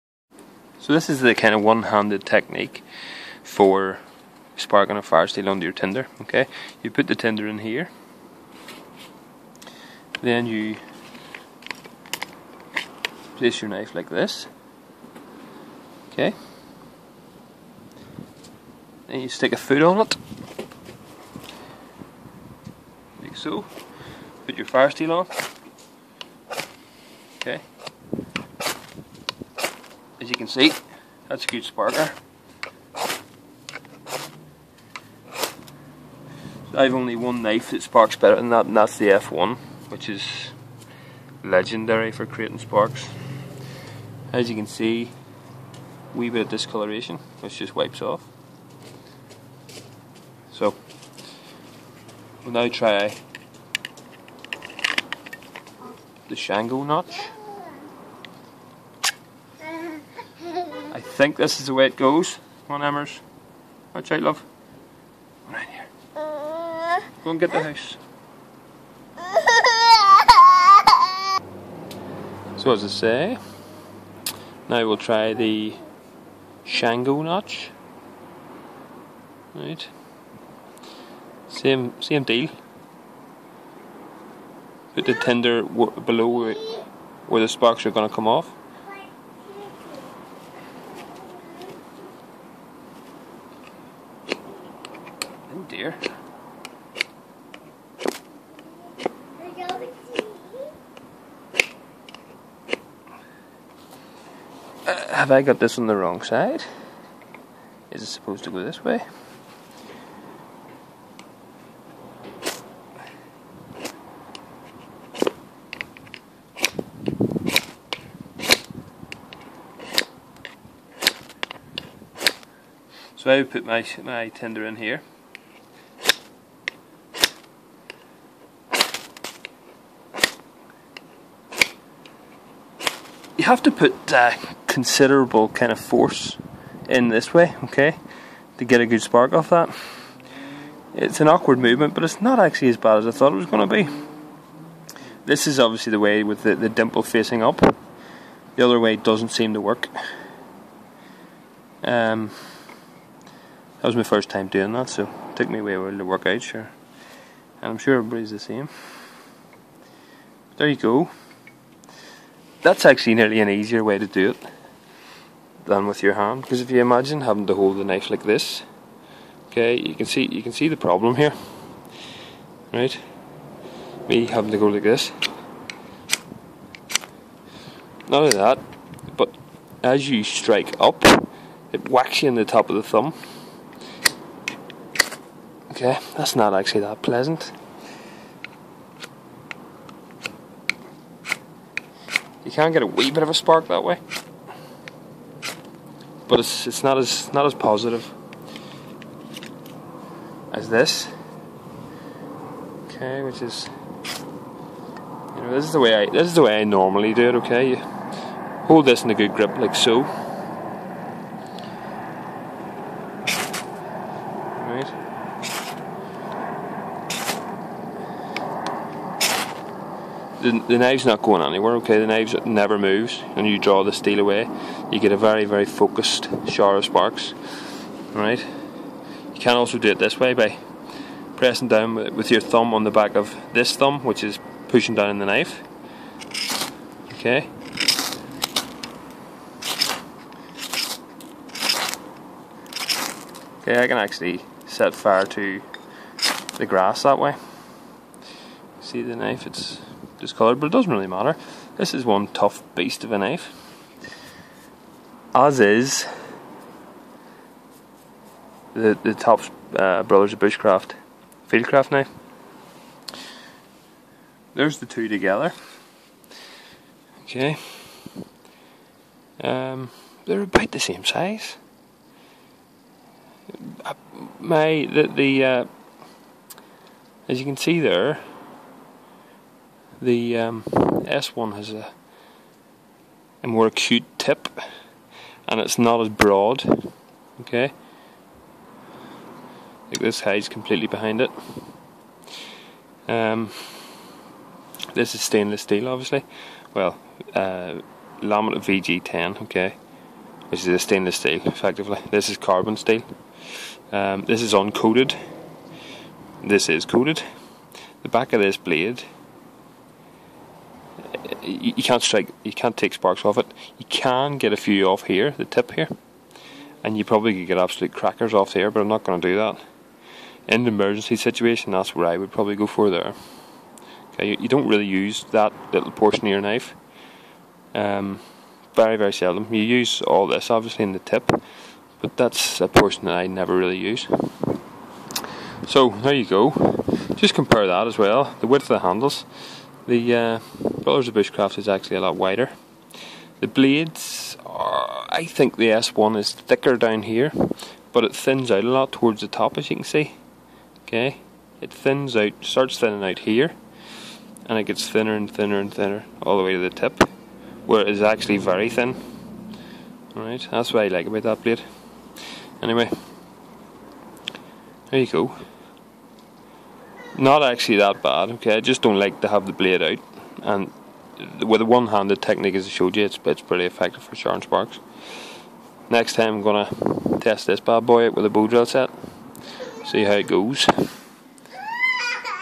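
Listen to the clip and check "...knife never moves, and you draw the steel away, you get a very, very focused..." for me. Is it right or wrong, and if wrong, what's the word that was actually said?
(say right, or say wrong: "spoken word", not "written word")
right.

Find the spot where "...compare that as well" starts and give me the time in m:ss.
5:37.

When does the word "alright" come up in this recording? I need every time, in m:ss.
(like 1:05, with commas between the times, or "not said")
3:48, 6:00.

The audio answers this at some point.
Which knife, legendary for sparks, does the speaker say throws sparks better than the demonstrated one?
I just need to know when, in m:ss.
0:38.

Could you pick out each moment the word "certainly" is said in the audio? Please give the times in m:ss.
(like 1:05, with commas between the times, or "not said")
not said.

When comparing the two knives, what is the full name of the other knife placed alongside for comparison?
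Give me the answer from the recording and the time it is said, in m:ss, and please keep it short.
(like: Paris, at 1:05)
Brothers of Bushcraft fieldcraft knife, at 4:20.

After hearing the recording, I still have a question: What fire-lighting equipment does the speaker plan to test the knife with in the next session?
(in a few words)
Bow drill set.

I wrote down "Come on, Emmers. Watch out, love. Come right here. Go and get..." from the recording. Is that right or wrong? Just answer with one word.
right.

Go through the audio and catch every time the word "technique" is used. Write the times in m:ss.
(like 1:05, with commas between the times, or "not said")
0:02, 6:12.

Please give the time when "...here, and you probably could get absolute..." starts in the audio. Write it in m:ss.
5:15.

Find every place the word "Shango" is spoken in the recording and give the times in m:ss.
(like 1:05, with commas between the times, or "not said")
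0:56, 1:16.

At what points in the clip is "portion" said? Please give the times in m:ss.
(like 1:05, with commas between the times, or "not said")
5:25, 5:32.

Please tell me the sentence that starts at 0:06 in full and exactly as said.
Okay, you put the tinder in here, then you place your knife like this.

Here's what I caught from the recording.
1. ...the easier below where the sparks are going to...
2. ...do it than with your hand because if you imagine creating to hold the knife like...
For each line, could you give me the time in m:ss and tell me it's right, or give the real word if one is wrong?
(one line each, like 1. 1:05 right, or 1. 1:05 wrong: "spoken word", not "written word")
1. 1:25 wrong: "tinder", not "easier"
2. 2:44 wrong: "having", not "creating".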